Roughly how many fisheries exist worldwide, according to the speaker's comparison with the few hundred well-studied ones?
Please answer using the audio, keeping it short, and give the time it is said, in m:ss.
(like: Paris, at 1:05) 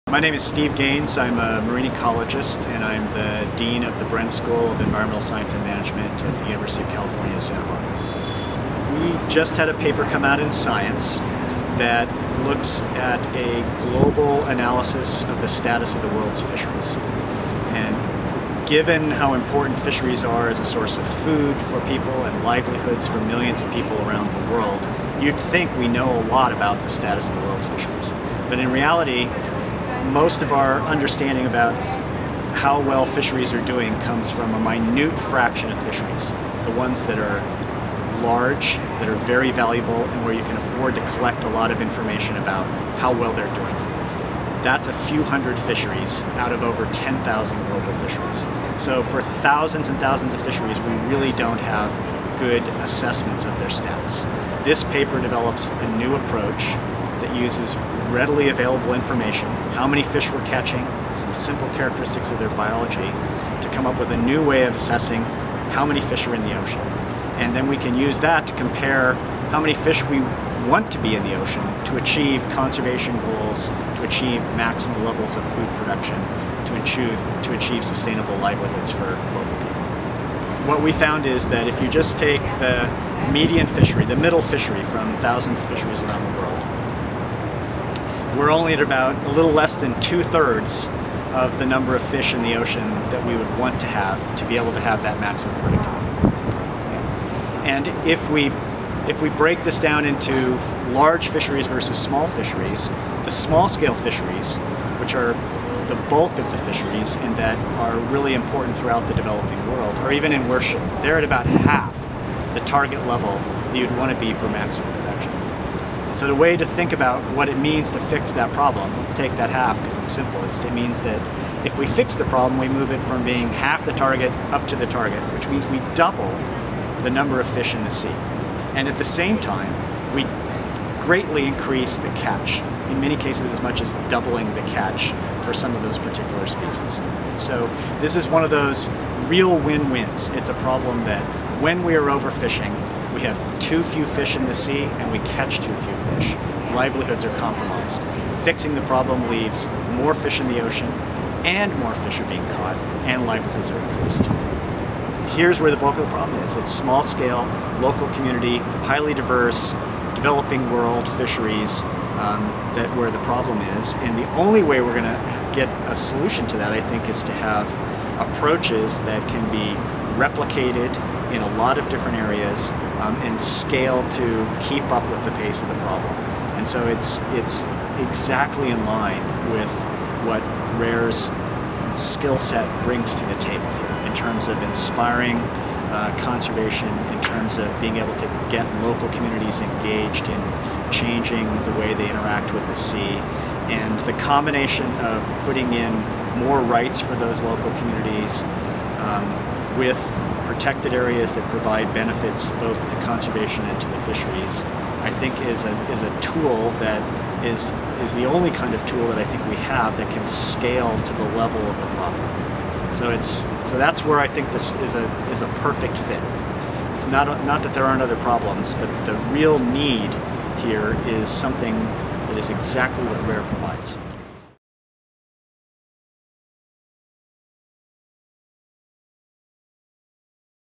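over 10,000, at 0:46.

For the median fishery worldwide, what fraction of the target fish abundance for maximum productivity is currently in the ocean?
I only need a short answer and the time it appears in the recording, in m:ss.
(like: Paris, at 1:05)
a little less than two-thirds, at 1:29.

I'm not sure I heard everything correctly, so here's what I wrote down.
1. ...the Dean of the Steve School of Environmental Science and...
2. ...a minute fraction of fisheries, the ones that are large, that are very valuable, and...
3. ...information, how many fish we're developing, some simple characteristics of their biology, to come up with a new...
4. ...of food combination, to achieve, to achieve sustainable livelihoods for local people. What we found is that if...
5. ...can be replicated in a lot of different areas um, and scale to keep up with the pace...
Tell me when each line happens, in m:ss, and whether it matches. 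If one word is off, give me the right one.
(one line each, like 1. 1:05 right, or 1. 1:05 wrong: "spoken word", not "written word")
1. 0:03 wrong: "Bren", not "Steve"
2. 0:34 right
3. 0:58 wrong: "catching", not "developing"
4. 1:15 wrong: "production", not "combination"
5. 2:49 right.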